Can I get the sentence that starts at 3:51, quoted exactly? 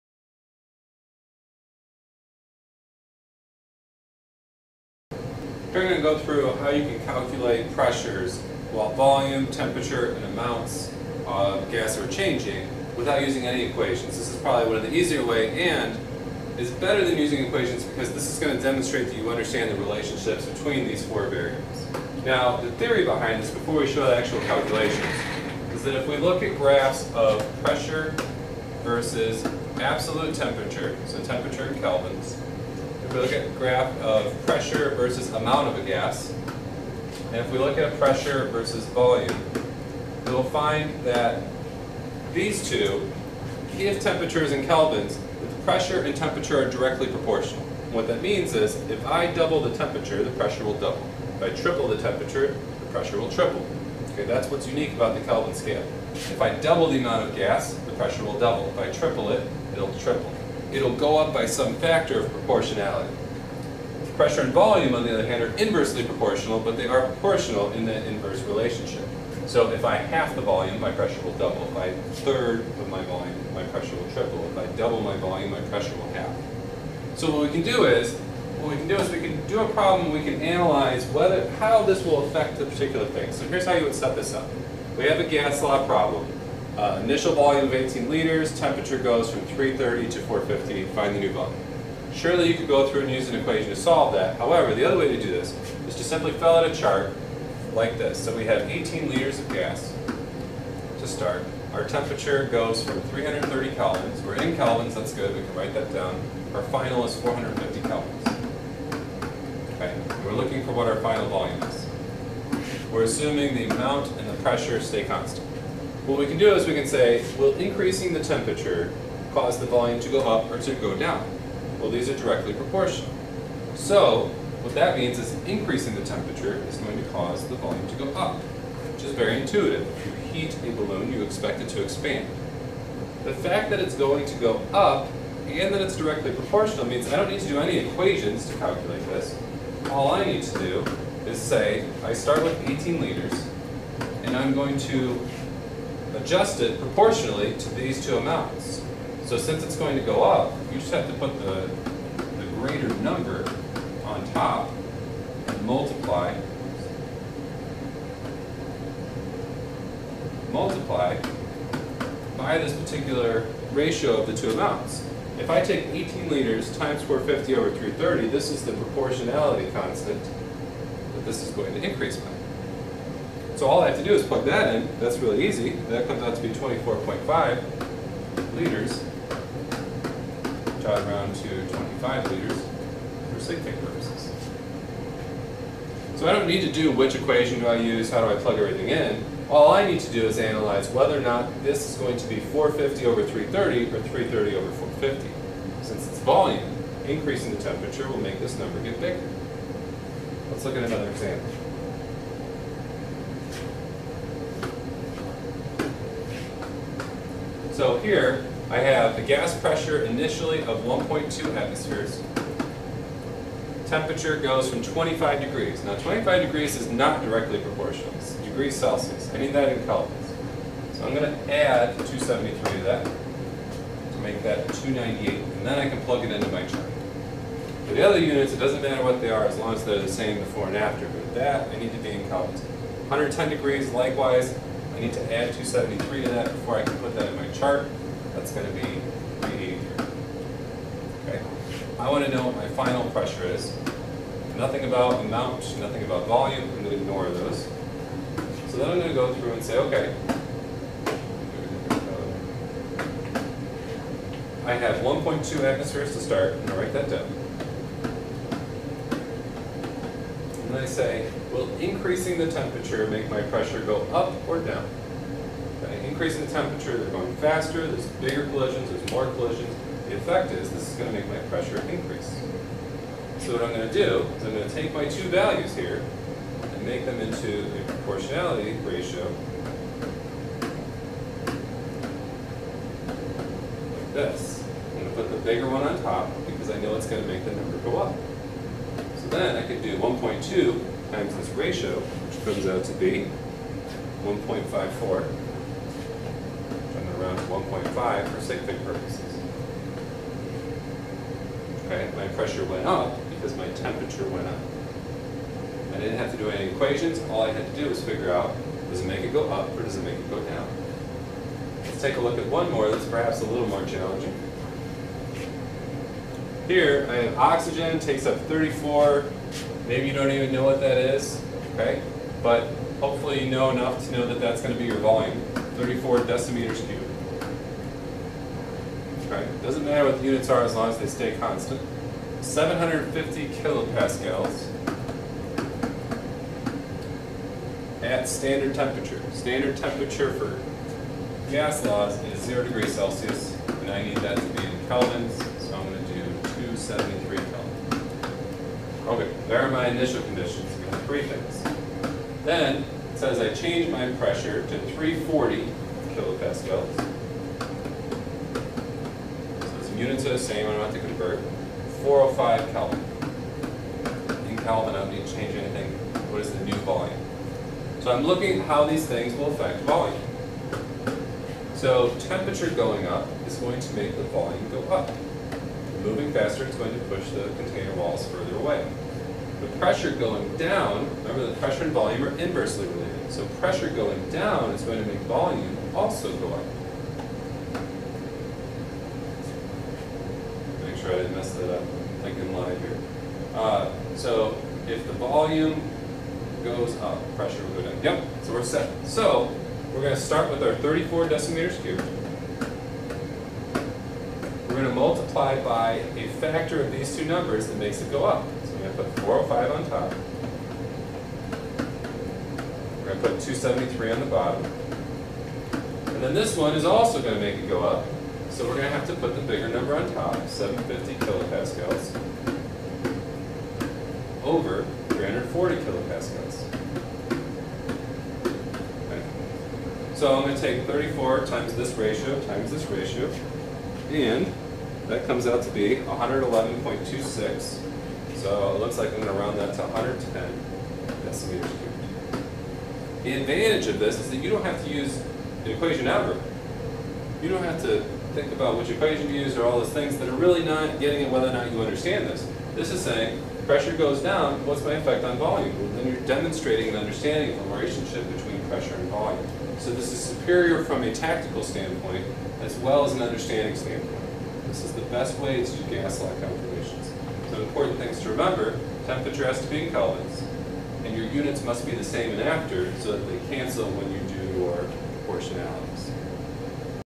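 But that, I need to be in Kelvins.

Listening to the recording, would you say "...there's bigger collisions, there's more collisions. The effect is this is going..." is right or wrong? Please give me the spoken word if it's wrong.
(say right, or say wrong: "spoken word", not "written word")
right.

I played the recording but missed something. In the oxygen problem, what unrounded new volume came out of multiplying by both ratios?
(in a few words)
111.26.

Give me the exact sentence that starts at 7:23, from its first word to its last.
The advantage of this is that you don't have to use the equation ever.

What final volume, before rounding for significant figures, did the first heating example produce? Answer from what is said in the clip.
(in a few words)
24.5 liters.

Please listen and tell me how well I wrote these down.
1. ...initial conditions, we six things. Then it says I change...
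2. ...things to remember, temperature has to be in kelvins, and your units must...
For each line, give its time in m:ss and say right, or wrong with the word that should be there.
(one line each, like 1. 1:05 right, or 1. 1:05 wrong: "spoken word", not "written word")
1. 5:49 wrong: "three", not "six"
2. 7:47 right.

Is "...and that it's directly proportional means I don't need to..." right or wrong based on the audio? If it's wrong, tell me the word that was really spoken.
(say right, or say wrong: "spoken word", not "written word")
right.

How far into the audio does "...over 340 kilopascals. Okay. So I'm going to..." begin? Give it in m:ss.
7:04.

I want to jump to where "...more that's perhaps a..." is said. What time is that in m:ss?
5:12.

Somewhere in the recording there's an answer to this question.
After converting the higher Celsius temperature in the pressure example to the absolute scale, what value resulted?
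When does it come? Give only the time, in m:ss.
3:59.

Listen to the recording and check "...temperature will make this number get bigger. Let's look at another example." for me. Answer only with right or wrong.
right.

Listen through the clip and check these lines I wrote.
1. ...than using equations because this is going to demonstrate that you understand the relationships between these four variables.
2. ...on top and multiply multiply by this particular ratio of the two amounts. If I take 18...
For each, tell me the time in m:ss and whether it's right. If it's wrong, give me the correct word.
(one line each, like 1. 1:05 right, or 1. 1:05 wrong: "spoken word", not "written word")
1. 0:17 right
2. 2:34 right.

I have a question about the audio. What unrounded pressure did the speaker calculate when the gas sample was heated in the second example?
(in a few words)
1.54.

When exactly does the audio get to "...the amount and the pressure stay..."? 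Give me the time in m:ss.
1:53.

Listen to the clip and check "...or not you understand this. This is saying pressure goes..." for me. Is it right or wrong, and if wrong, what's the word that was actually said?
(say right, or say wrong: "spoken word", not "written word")
right.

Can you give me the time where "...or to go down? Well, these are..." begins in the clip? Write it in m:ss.
2:00.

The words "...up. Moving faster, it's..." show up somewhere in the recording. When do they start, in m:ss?
6:14.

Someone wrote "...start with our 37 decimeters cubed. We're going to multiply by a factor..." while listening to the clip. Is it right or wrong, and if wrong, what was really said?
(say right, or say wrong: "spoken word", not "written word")
wrong: "34", not "37".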